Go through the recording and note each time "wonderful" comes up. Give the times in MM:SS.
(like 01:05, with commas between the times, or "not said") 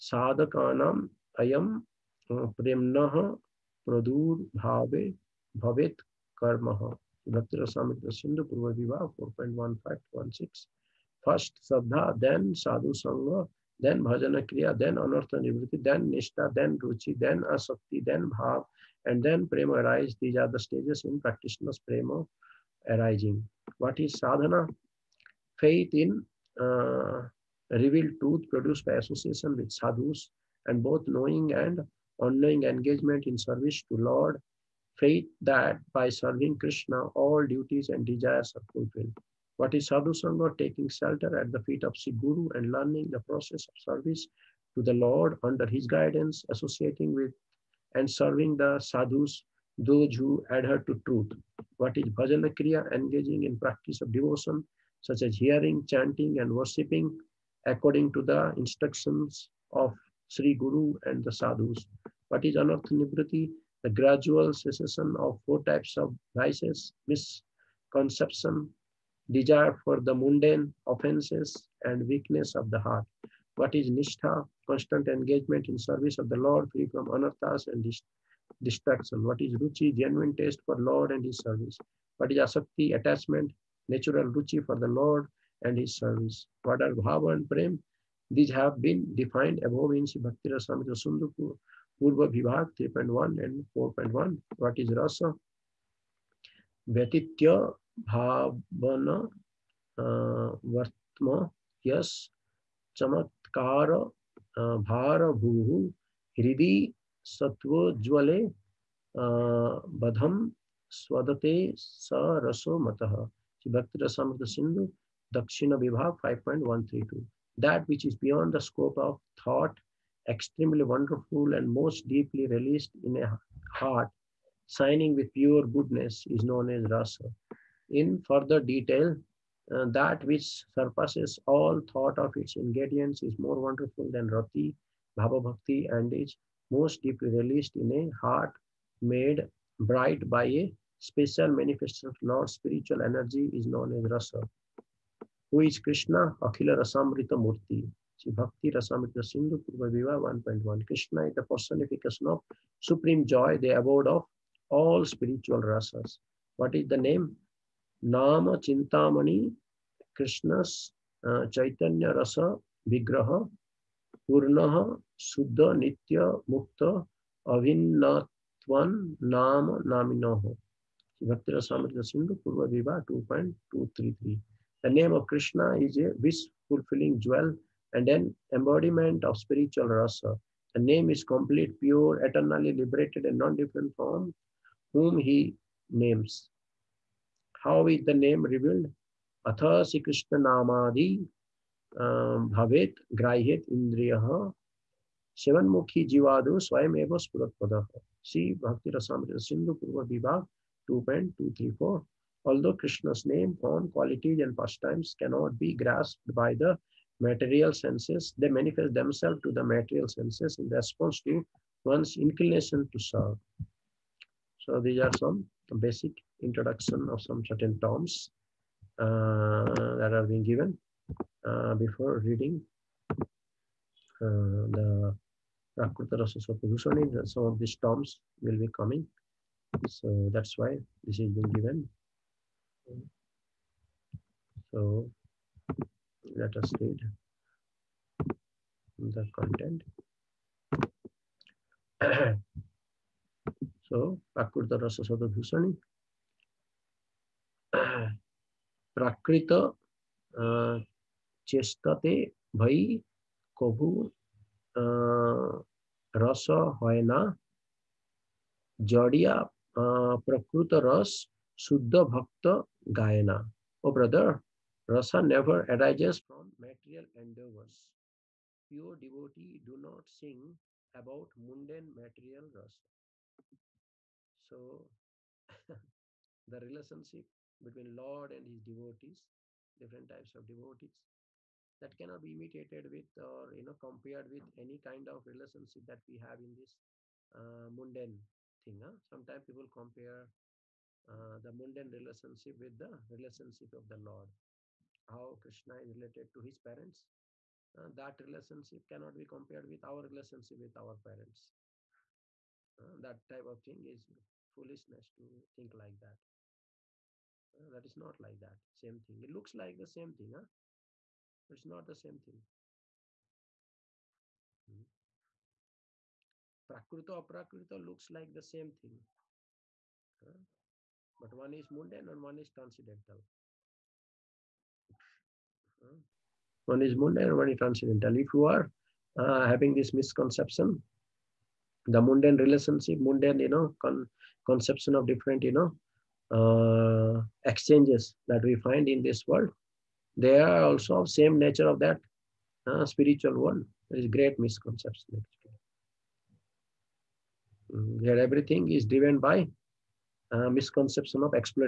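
02:00, 02:13.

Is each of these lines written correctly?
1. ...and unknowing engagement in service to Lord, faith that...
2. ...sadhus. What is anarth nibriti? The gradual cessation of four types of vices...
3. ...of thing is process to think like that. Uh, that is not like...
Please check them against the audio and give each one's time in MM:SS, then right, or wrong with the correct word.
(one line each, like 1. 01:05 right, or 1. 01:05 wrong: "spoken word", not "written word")
1. 00:31 right
2. 01:01 right
3. 05:03 wrong: "foolishness", not "process".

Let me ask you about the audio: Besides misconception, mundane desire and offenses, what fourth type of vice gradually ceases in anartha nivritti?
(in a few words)
Weakness of the heart.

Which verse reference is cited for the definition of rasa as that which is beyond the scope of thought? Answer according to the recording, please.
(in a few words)
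Dakshina 5.132.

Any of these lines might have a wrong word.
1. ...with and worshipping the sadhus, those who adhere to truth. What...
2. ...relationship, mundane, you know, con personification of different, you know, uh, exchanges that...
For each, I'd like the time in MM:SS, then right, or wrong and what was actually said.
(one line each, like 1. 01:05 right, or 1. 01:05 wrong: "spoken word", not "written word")
1. 00:47 wrong: "serving", not "worshipping"
2. 05:32 wrong: "conception", not "personification".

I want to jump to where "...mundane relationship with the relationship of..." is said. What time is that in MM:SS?
04:51.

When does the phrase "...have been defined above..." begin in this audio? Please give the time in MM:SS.
01:28.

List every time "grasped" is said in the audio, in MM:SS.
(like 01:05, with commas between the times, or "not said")
03:25.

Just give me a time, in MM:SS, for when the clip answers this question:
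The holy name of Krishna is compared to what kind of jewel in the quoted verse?
02:56.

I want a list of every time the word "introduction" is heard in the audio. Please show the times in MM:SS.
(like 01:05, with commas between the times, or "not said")
03:36.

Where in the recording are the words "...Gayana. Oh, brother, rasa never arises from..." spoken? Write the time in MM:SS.
04:22.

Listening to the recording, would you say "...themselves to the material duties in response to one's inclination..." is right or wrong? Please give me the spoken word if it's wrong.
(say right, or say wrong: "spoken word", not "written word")
wrong: "senses", not "duties".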